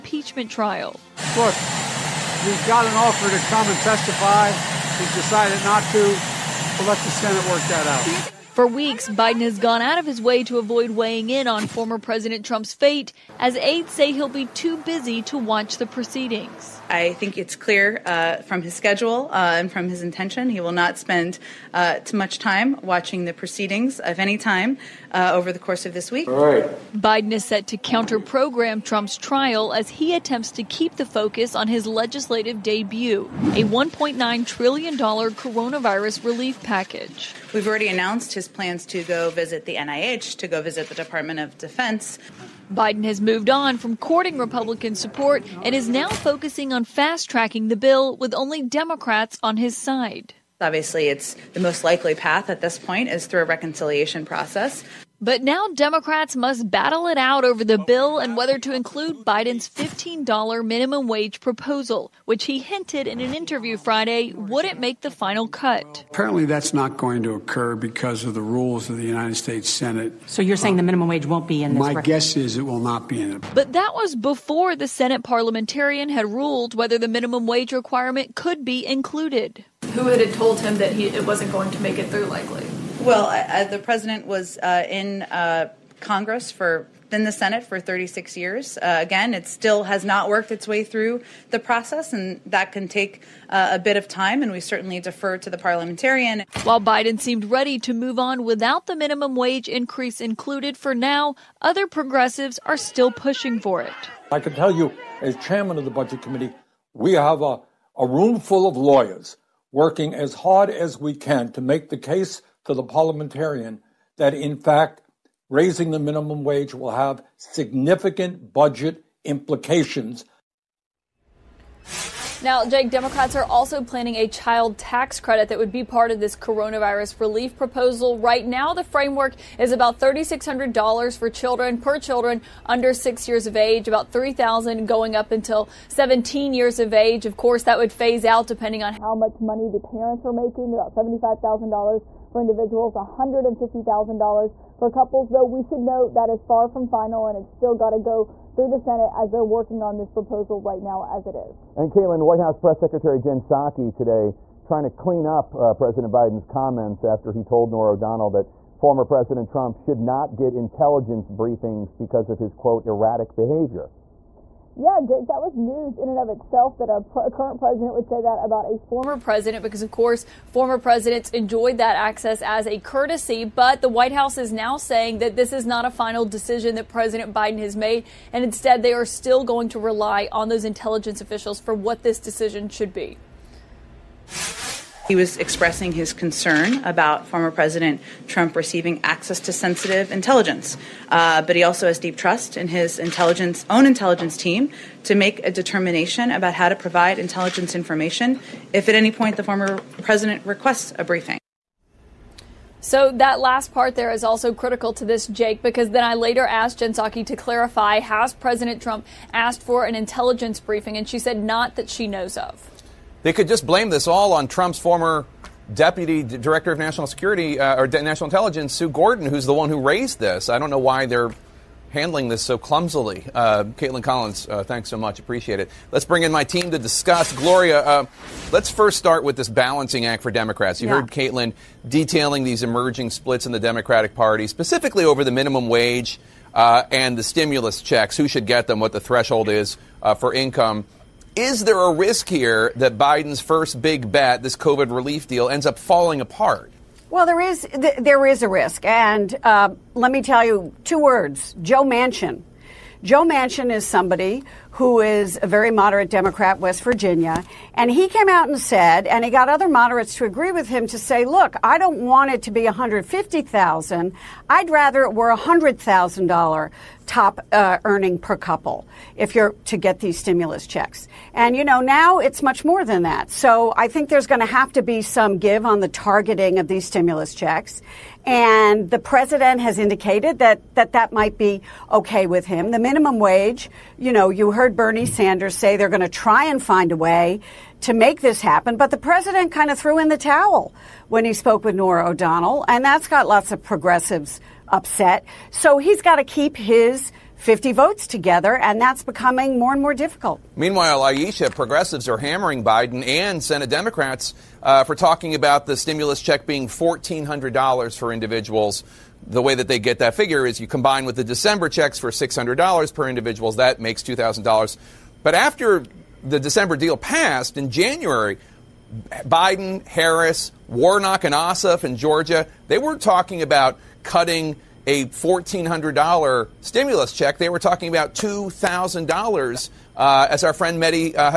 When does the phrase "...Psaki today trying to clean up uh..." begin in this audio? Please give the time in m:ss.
2:33.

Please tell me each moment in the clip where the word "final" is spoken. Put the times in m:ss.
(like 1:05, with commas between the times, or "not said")
1:05, 2:26, 2:55.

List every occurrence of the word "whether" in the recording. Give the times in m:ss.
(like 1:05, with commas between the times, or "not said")
0:58, 1:16.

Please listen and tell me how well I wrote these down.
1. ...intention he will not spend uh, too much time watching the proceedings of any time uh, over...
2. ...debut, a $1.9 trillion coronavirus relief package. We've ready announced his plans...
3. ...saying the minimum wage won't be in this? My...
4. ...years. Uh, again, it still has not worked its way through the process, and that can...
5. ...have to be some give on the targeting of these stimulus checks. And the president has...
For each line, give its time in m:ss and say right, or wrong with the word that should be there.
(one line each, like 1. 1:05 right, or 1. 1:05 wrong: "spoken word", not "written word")
1. 0:20 right
2. 0:32 wrong: "already", not "ready"
3. 1:10 right
4. 1:28 right
5. 4:34 right.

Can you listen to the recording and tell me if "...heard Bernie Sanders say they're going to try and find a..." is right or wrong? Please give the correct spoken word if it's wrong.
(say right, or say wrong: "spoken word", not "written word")
right.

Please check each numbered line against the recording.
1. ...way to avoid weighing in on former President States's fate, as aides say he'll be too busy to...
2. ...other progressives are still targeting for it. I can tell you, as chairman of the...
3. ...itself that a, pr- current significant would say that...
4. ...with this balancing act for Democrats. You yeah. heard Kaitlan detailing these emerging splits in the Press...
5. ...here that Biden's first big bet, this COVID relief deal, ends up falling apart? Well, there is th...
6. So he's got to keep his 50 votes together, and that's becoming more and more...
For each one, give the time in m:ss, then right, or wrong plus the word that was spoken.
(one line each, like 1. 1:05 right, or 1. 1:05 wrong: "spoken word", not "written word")
1. 0:10 wrong: "Trump", not "States"
2. 1:41 wrong: "pushing", not "targeting"
3. 2:46 wrong: "president", not "significant"
4. 3:49 wrong: "Democratic", not "Press"
5. 4:02 right
6. 4:55 right.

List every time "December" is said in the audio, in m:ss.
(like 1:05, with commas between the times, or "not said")
5:11, 5:16.